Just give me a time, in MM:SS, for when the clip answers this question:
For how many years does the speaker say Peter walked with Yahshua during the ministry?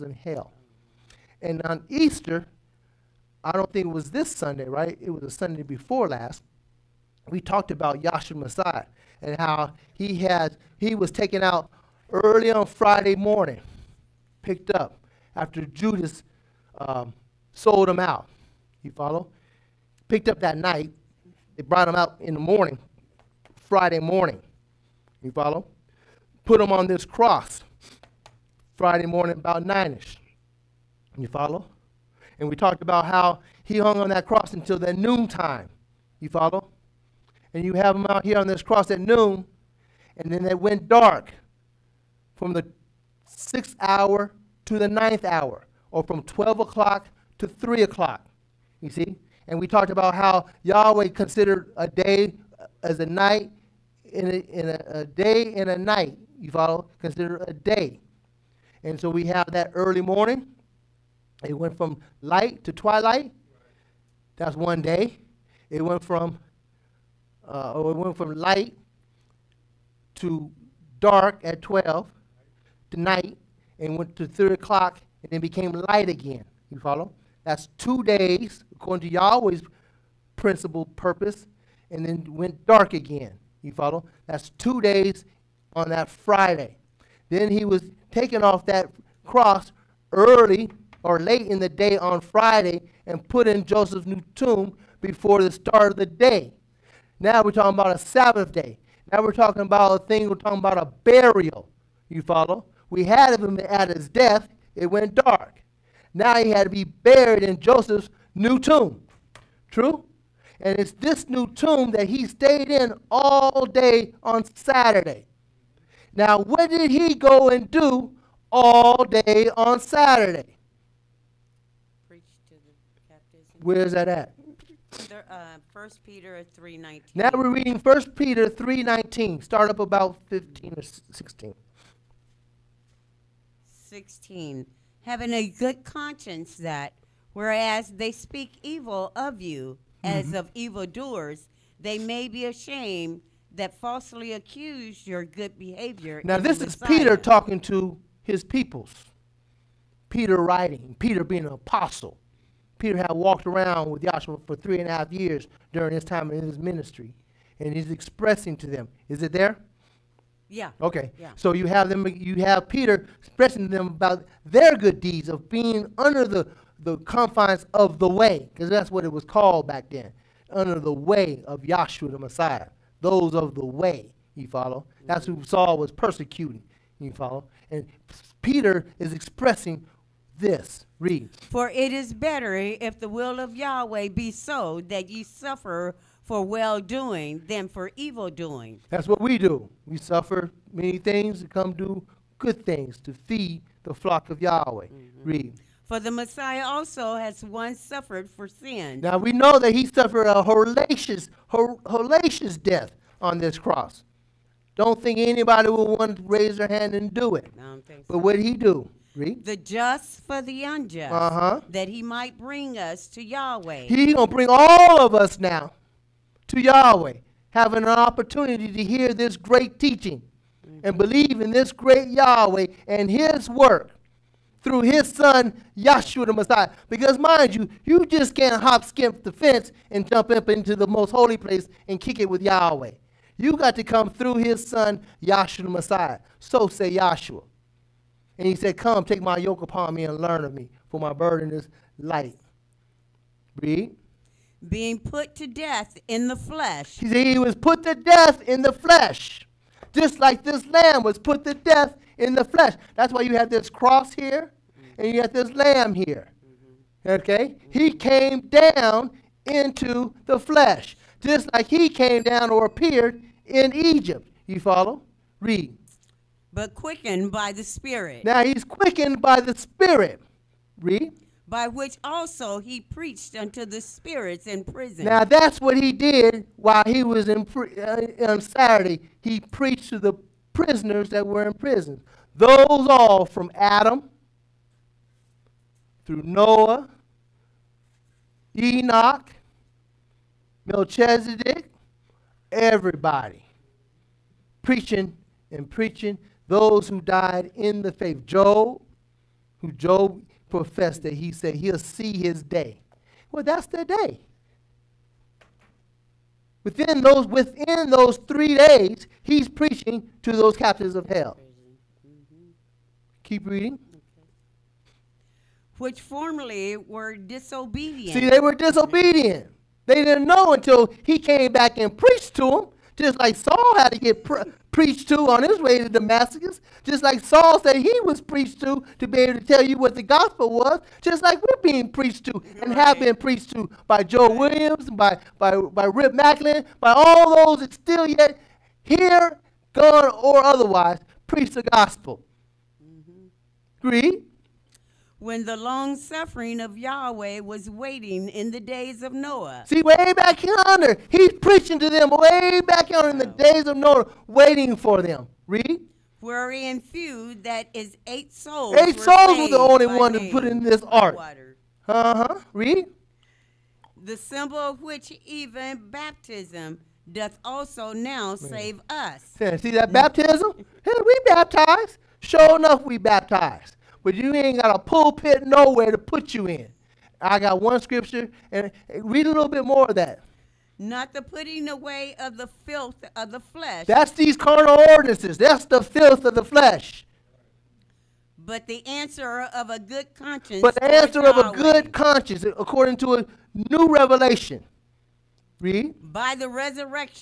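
02:34.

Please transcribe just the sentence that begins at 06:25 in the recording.
That's the filth of the flesh.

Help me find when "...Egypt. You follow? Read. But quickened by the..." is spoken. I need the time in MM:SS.
04:23.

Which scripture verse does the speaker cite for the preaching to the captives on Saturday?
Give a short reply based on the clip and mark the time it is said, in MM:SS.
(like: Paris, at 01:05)
First Peter 3:19, at 02:05.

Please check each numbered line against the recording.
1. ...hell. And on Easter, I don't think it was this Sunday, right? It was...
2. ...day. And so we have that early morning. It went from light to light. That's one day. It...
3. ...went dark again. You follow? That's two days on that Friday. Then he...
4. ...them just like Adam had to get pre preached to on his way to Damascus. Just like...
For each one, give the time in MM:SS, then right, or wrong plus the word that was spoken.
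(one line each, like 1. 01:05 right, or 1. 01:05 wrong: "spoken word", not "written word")
1. 00:00 right
2. 00:57 wrong: "twilight", not "light"
3. 01:22 right
4. 05:22 wrong: "Saul", not "Adam".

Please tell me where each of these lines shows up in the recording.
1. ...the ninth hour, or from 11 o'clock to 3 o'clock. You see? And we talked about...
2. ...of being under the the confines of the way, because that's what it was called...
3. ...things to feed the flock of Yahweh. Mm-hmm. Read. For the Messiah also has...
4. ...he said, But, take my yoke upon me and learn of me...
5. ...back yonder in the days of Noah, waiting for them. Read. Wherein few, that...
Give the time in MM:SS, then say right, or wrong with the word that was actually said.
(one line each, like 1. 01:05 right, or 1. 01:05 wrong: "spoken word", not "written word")
1. 00:44 wrong: "12", not "11"
2. 02:45 right
3. 03:12 right
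4. 03:58 wrong: "Come", not "But"
5. 05:52 right.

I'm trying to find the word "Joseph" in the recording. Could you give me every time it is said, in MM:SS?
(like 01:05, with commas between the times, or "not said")
01:33, 01:47.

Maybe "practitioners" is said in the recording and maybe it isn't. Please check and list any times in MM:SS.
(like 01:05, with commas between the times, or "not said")
not said.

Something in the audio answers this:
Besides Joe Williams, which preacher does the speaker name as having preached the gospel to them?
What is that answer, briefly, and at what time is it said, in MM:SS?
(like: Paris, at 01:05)
Rip Macklin, at 05:35.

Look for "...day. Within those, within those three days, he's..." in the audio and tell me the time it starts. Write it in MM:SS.
05:03.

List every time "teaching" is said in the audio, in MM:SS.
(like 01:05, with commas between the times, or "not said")
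03:39.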